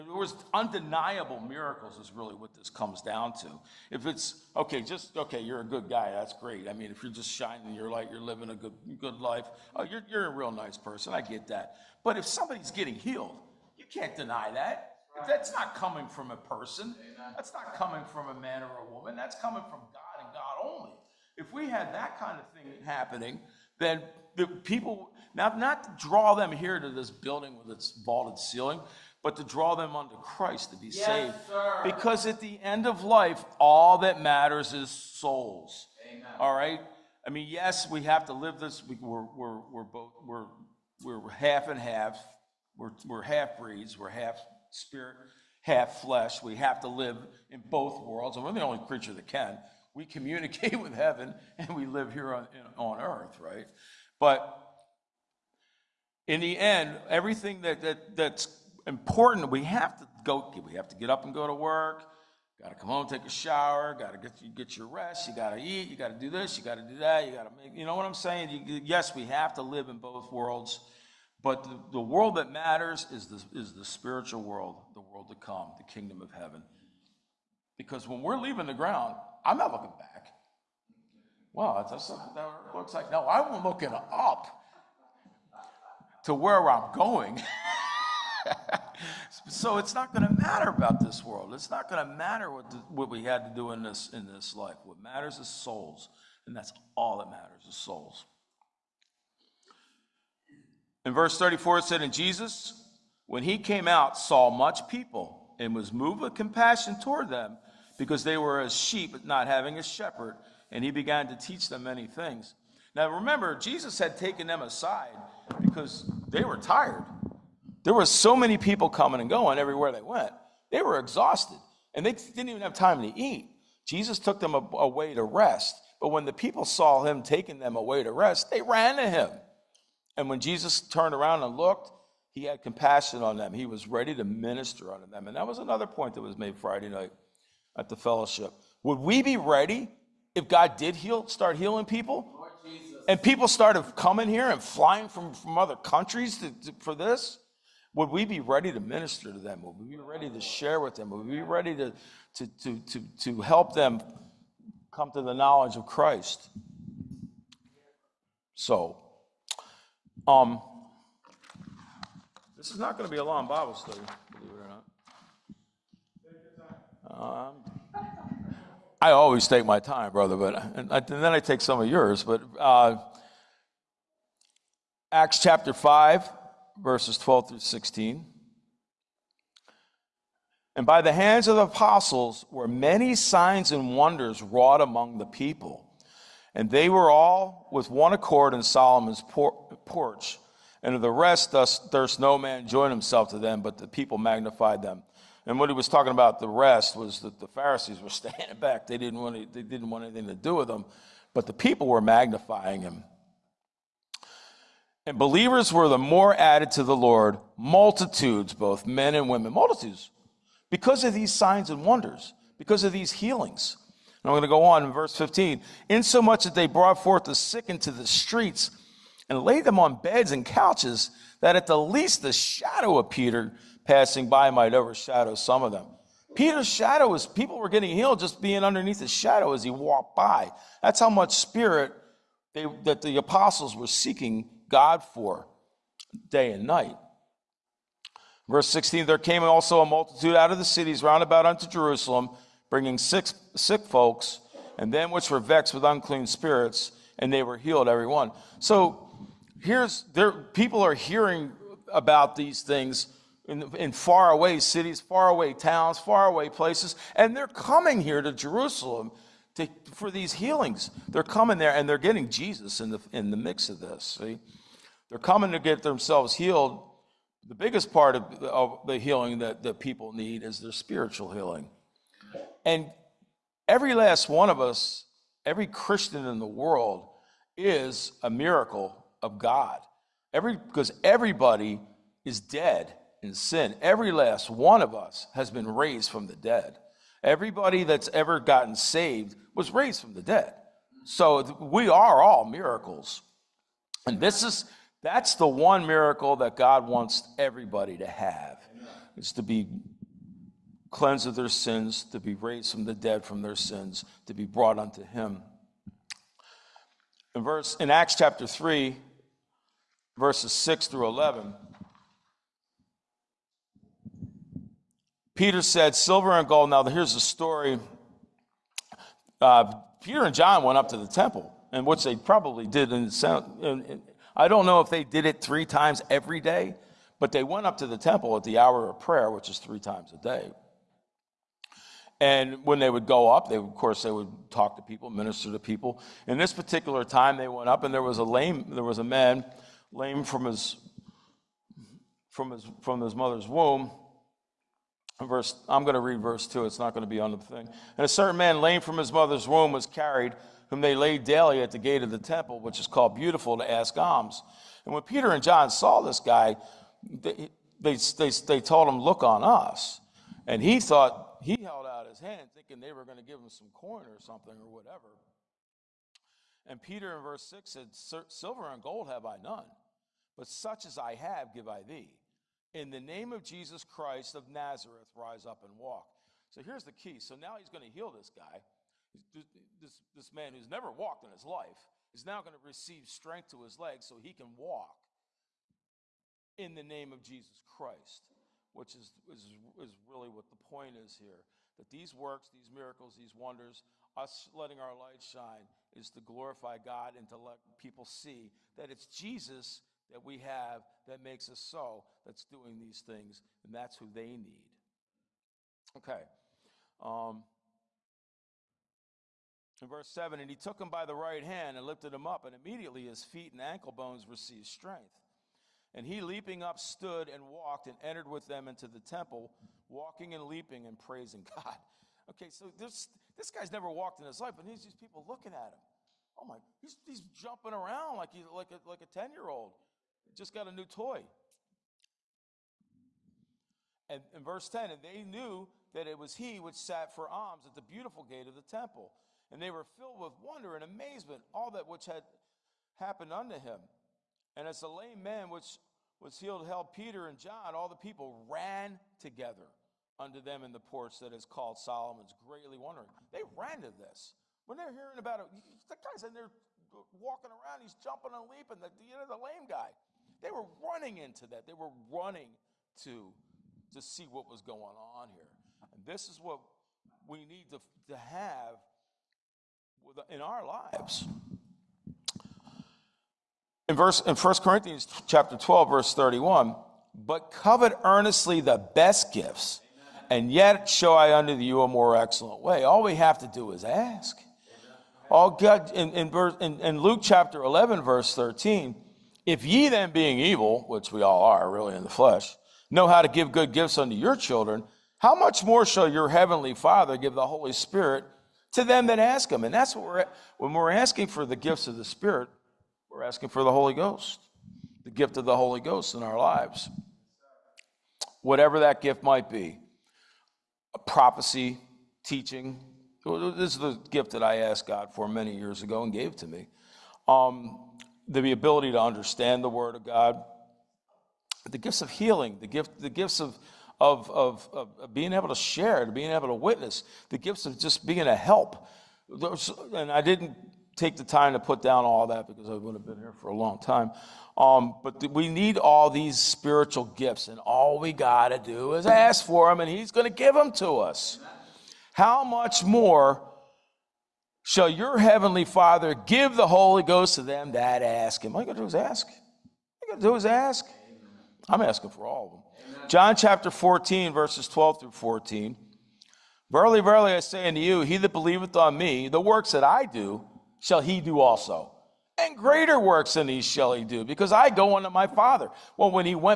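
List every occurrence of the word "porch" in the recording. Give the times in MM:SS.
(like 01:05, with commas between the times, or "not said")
03:09, 07:30.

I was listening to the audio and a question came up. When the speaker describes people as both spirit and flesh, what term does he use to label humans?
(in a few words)
half breeds.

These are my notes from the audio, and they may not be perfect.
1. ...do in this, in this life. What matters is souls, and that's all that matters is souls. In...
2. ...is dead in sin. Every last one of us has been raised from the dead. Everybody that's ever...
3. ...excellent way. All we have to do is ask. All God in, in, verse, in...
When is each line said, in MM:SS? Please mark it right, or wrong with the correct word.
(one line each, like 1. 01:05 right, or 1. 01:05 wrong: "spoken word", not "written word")
1. 01:33 right
2. 04:42 right
3. 08:02 right.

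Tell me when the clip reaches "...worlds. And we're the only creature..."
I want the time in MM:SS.
00:48.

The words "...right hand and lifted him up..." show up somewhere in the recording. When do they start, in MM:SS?
06:51.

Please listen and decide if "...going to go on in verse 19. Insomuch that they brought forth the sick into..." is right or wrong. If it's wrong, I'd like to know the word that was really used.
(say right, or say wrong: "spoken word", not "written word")
wrong: "15", not "19".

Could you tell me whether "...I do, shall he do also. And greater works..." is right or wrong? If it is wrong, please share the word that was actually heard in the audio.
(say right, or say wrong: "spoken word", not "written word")
right.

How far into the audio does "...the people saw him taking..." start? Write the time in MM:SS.
02:06.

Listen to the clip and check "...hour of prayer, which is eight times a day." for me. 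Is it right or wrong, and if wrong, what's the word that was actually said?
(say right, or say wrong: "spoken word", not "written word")
wrong: "three", not "eight".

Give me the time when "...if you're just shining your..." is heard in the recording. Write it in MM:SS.
00:06.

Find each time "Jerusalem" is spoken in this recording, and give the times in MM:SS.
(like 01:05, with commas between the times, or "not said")
04:01, 04:18.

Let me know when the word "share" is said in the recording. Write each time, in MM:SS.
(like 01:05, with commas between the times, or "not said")
02:30, 08:45.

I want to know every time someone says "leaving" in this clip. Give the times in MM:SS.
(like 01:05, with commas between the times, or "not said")
01:18.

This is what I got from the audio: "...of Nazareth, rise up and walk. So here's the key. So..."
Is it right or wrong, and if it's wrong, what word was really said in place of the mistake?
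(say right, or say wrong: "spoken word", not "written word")
right.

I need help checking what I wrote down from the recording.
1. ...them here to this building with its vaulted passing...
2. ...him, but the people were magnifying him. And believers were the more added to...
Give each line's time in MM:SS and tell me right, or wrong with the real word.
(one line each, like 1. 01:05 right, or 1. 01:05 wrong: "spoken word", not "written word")
1. 00:26 wrong: "ceiling", not "passing"
2. 03:20 right.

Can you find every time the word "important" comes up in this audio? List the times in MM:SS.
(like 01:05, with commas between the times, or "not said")
00:58.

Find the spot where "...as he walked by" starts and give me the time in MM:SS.
03:49.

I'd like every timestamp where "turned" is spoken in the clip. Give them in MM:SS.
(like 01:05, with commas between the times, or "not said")
02:10.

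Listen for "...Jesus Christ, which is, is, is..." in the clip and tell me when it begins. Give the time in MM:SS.
06:27.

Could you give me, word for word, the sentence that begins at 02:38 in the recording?
So, um, this is not going to be a long Bible study, believe it or not.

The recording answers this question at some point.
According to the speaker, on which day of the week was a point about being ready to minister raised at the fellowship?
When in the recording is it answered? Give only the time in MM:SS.
02:16.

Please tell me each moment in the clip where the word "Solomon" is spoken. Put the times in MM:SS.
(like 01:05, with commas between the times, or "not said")
03:08, 07:31.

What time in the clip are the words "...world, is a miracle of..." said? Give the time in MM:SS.
04:36.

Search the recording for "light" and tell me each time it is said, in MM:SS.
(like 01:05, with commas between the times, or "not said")
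00:07, 06:34.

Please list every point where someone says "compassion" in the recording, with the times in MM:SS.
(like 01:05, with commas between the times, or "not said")
01:46, 02:12.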